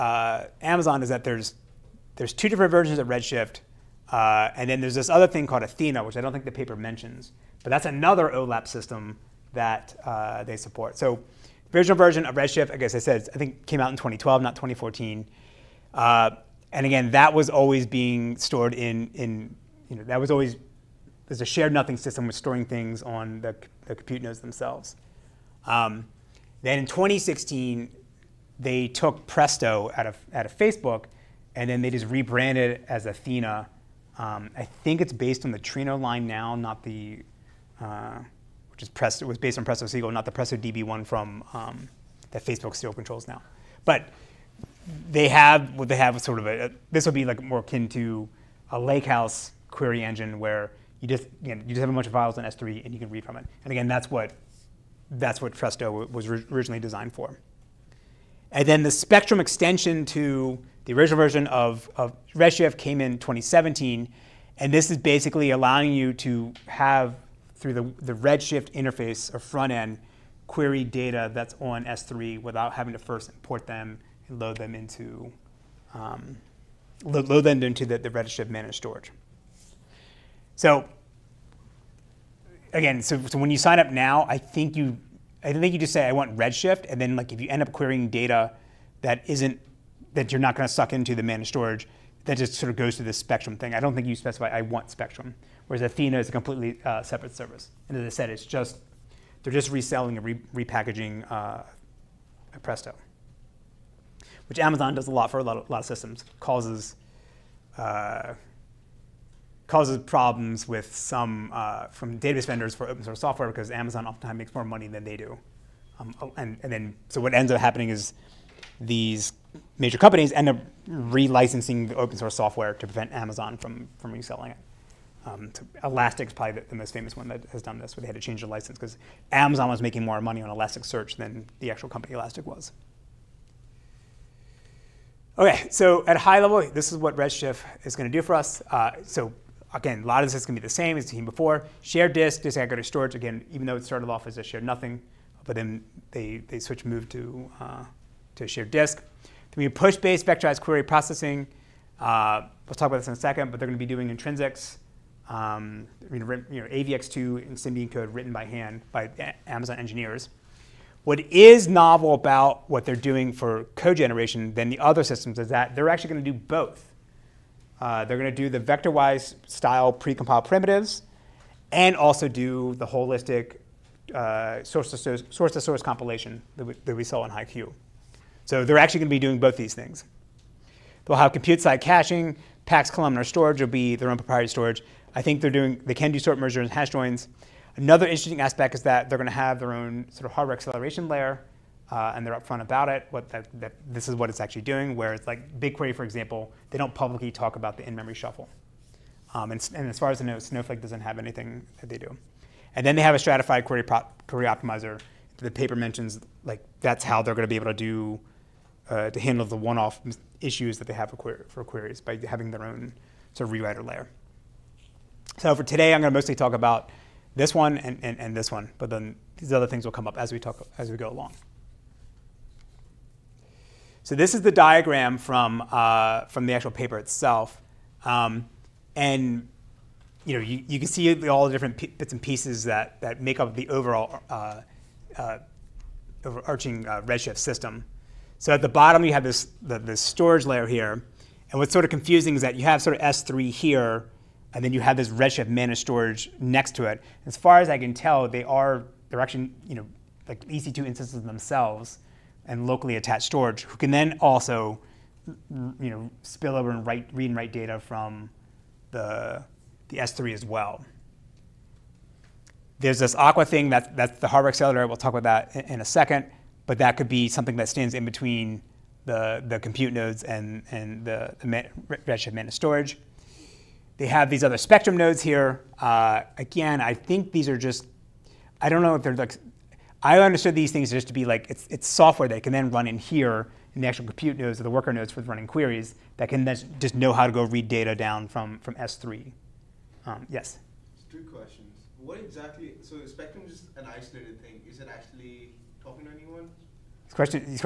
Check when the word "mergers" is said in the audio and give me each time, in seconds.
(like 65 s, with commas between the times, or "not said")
186 s.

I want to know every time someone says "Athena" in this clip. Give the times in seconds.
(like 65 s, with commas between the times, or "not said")
5 s, 33 s, 95 s.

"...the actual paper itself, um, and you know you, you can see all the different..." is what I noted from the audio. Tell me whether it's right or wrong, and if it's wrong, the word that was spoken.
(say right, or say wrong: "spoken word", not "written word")
right.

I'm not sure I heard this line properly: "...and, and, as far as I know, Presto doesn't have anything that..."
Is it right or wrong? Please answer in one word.
wrong.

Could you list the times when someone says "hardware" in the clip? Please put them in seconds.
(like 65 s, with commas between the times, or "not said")
190 s, 264 s.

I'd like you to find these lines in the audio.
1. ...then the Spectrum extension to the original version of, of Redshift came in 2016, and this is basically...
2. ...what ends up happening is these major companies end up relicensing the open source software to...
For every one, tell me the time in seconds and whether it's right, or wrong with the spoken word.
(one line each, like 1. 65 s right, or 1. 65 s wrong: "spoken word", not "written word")
1. 58 s wrong: "2017", not "2016"
2. 117 s right.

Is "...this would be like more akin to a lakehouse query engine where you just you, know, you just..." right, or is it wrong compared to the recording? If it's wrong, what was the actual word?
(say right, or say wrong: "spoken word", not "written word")
right.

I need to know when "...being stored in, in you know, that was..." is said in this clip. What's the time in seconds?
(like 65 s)
17 s.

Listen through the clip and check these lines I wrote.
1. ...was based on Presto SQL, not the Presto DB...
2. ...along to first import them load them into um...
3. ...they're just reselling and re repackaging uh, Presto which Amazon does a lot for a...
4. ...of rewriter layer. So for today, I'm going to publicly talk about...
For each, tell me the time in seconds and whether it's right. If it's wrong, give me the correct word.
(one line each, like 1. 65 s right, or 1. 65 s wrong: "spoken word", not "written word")
1. 39 s right
2. 72 s wrong: "having", not "along"
3. 99 s right
4. 213 s wrong: "mostly", not "publicly".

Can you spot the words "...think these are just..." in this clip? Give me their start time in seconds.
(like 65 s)
276 s.